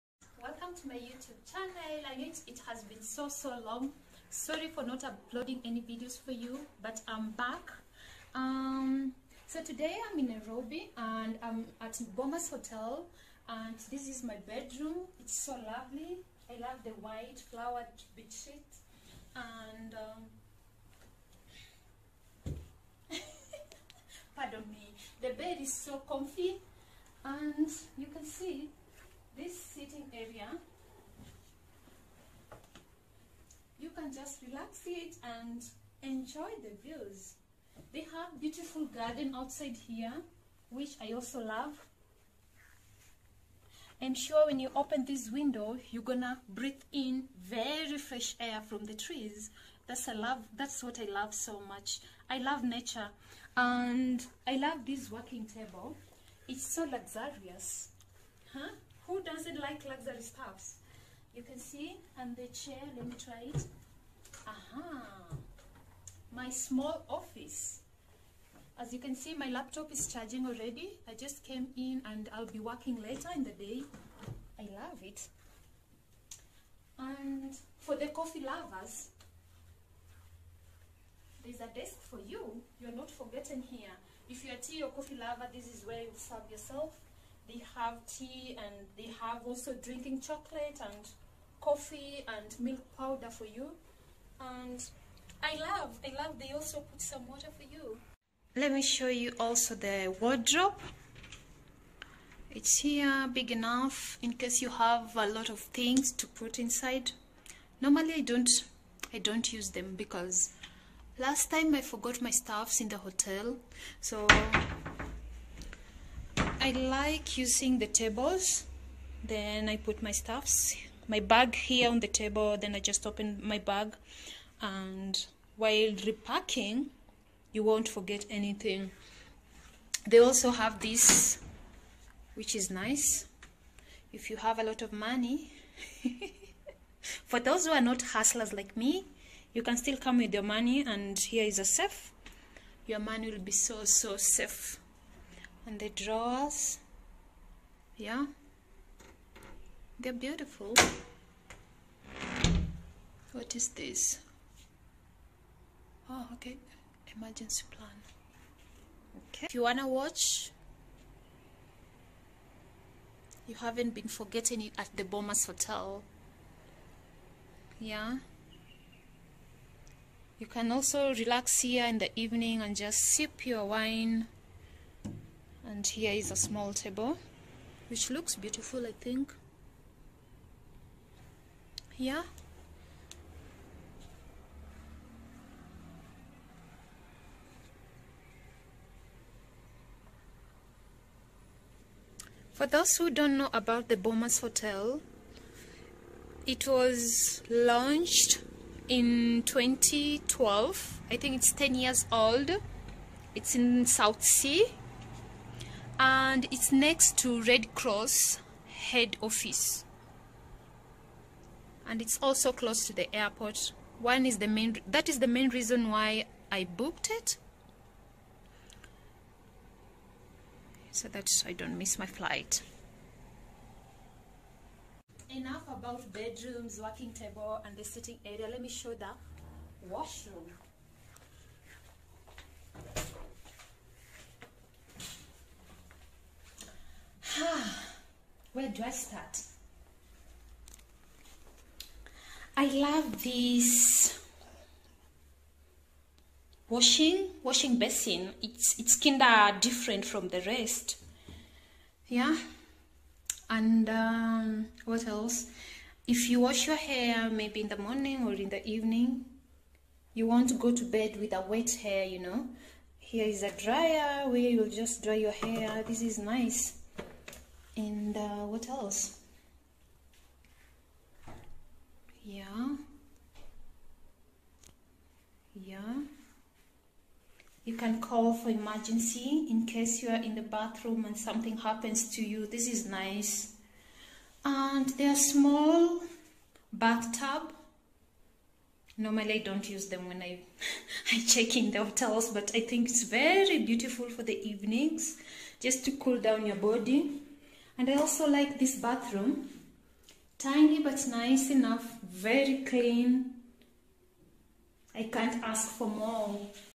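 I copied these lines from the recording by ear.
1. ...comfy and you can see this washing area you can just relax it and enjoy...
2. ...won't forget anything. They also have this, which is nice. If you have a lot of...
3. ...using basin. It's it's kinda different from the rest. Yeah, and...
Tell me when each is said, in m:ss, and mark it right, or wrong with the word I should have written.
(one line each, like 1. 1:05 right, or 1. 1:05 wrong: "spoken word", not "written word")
1. 0:26 wrong: "sitting", not "washing"
2. 2:07 right
3. 4:07 wrong: "washing", not "using".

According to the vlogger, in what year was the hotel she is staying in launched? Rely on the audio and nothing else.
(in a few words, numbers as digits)
2012.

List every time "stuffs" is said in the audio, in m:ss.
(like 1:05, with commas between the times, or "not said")
1:00, 1:52, 2:00.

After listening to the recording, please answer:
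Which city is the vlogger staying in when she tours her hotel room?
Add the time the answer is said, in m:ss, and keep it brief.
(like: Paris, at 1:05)
Nairobi, at 0:10.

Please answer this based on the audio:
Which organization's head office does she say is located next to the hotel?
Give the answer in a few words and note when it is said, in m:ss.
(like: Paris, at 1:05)
Red Cross, at 3:27.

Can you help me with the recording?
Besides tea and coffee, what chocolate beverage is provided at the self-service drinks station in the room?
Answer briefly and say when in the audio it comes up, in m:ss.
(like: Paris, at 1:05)
Drinking chocolate, at 1:29.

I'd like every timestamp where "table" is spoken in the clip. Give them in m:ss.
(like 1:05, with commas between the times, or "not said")
0:55, 1:57, 2:02, 2:56, 3:47.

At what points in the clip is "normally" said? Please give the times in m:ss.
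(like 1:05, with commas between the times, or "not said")
1:47, 4:48.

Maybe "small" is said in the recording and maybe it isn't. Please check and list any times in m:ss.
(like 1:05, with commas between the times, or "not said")
1:06, 2:56, 4:45.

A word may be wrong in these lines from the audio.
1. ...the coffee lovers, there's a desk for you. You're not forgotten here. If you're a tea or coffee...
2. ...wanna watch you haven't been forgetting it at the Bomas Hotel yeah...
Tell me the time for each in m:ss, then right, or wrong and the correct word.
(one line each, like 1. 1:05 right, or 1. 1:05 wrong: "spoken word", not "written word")
1. 1:17 right
2. 2:39 right.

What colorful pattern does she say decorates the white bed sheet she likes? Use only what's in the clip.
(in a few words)
Flowered.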